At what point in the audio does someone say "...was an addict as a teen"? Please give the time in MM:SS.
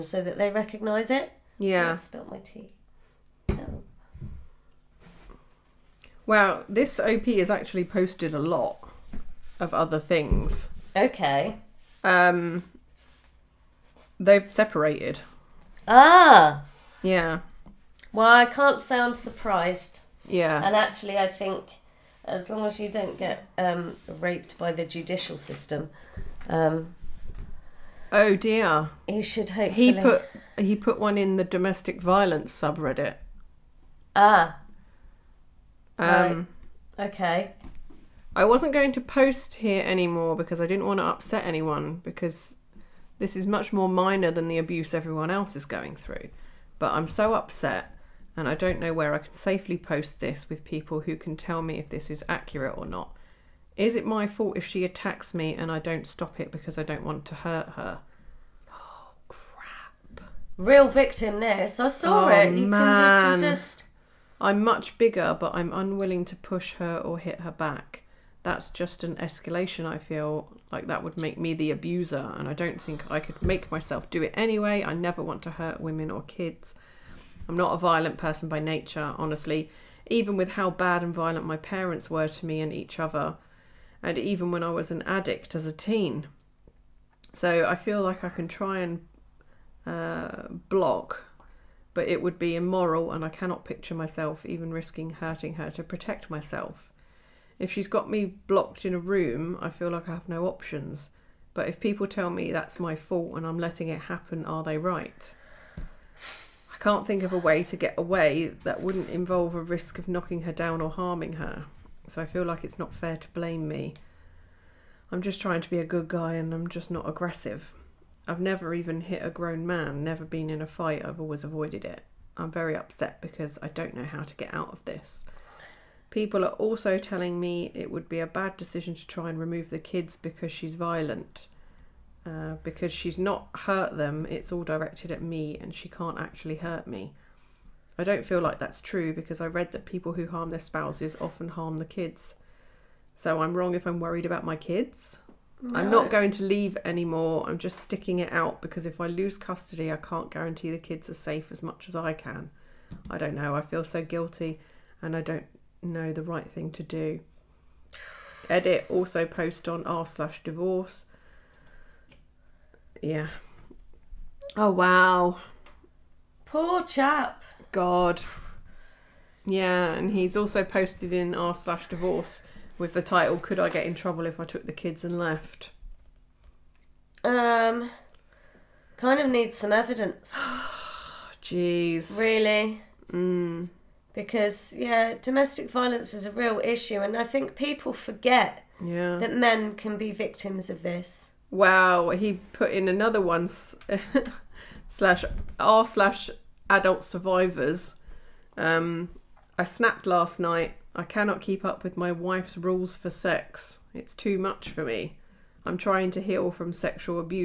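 01:24.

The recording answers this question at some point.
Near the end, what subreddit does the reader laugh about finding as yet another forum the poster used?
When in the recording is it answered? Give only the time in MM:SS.
03:16.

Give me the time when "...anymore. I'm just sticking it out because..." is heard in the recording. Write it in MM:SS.
02:26.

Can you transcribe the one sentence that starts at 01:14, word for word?
I never want to hurt women or kids.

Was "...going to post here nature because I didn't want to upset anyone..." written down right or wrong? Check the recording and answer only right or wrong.
wrong.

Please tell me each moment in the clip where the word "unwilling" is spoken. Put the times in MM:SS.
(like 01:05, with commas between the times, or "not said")
01:05.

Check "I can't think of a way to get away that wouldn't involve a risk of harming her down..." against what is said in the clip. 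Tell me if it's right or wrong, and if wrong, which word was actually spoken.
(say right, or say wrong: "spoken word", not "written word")
wrong: "knocking", not "harming".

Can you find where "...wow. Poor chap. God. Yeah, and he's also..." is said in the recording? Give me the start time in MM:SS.
02:44.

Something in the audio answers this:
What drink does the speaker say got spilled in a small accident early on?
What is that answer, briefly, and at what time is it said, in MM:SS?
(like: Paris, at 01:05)
tea, at 00:02.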